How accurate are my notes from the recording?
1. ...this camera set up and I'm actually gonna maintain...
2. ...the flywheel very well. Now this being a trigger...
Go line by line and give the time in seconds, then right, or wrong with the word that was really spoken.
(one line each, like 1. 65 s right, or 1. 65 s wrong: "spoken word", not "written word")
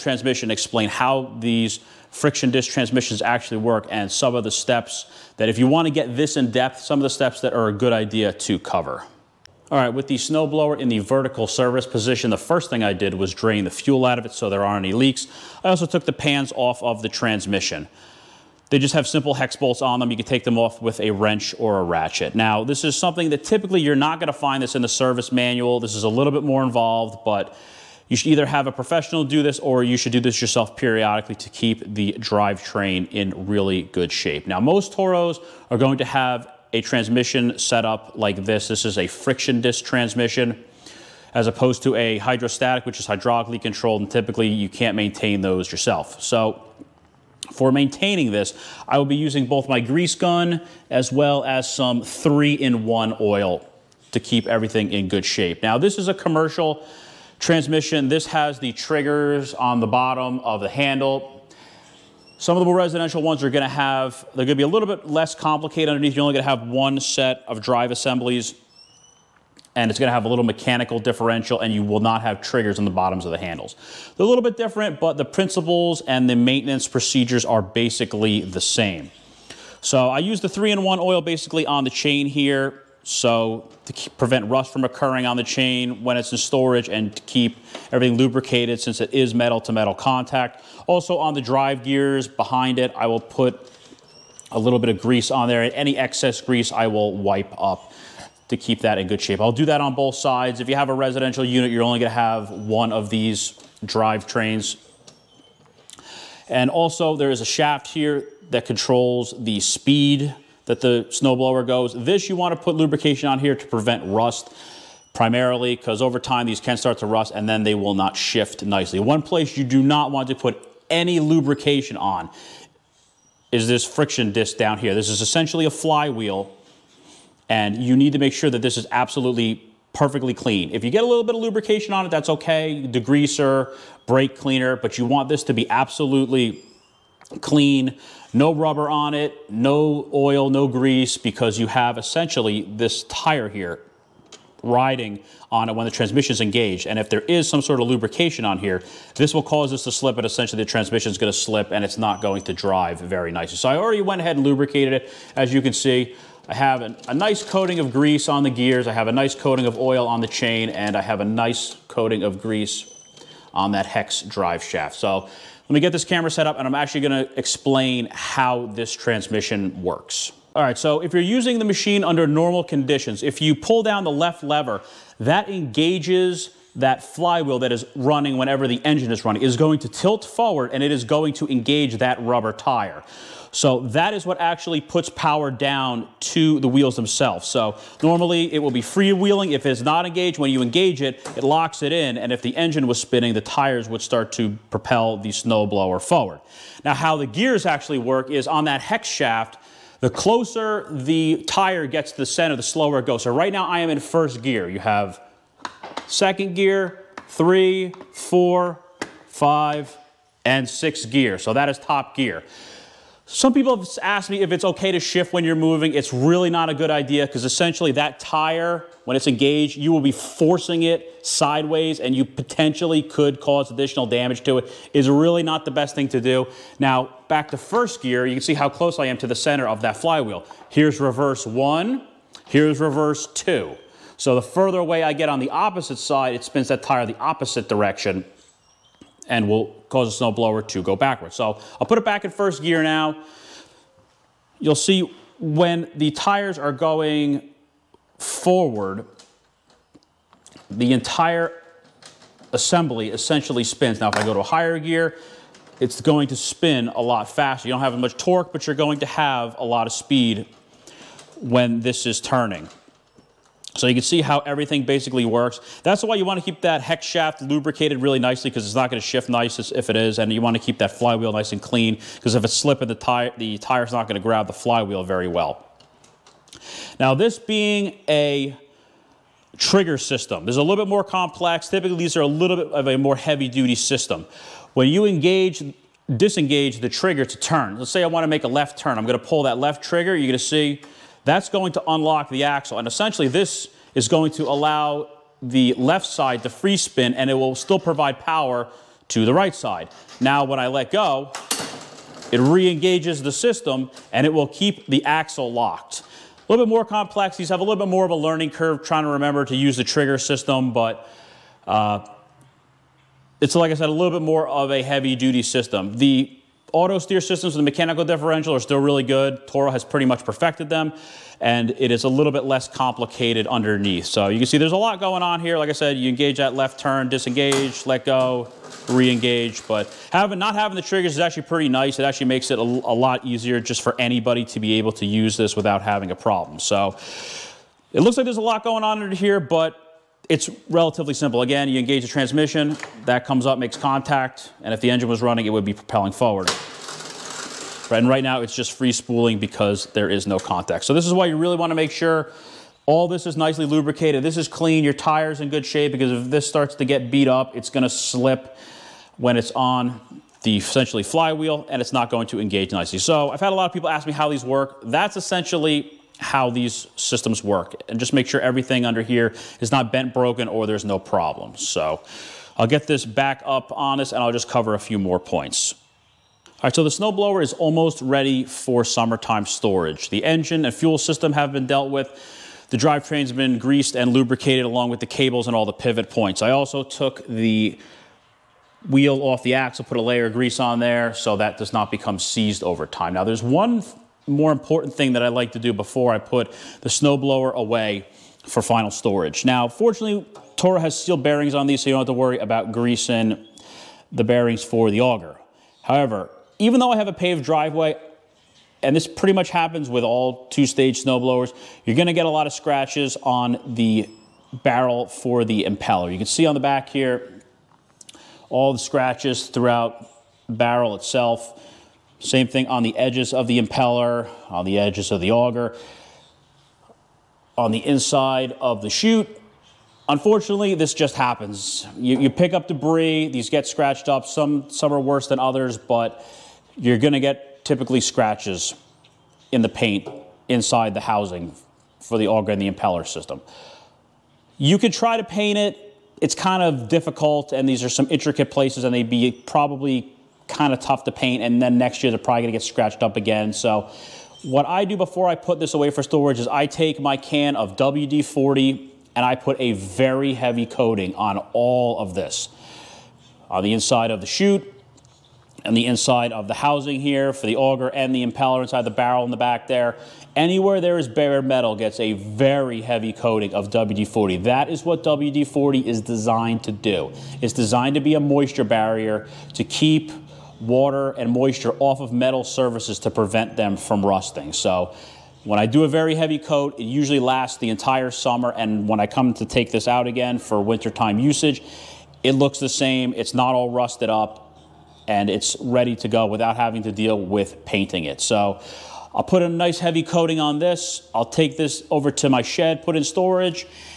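1. 165 s wrong: "explain", not "maintain"
2. 274 s right.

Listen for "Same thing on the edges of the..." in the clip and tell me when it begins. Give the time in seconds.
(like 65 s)
422 s.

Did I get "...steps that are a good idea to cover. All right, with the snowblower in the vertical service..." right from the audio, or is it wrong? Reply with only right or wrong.
right.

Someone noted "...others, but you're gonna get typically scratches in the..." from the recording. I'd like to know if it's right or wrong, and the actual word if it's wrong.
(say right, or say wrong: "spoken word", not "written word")
right.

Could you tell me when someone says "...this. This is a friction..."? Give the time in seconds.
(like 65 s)
38 s.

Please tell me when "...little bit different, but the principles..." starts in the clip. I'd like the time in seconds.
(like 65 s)
74 s.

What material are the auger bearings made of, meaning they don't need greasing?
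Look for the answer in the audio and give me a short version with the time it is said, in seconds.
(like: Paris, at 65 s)
steel, at 401 s.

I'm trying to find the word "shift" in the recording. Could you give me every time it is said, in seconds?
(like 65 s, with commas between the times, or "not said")
118 s, 215 s, 269 s.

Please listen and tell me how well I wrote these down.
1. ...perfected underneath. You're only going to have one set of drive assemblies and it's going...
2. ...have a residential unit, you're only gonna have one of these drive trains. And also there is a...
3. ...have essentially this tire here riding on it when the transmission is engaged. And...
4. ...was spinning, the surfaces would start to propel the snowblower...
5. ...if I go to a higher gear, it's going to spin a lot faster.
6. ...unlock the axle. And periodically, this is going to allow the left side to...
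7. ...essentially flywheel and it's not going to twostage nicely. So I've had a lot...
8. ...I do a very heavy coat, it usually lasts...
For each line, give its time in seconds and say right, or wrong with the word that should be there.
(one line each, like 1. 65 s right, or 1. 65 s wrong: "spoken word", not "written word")
1. 65 s wrong: "complicated", not "perfected"
2. 100 s right
3. 141 s right
4. 192 s wrong: "tires", not "surfaces"
5. 254 s right
6. 291 s wrong: "essentially", not "periodically"
7. 360 s wrong: "engage", not "twostage"
8. 485 s right.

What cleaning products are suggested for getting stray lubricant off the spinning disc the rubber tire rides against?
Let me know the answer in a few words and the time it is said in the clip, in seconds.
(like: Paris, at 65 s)
degreaser, brake cleaner, at 132 s.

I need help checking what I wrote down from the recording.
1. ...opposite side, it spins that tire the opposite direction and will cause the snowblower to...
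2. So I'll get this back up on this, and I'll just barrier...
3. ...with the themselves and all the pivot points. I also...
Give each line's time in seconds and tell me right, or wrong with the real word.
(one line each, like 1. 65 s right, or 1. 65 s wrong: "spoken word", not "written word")
1. 235 s right
2. 371 s wrong: "cover", not "barrier"
3. 384 s wrong: "cables", not "themselves".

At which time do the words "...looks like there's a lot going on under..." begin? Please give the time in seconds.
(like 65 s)
338 s.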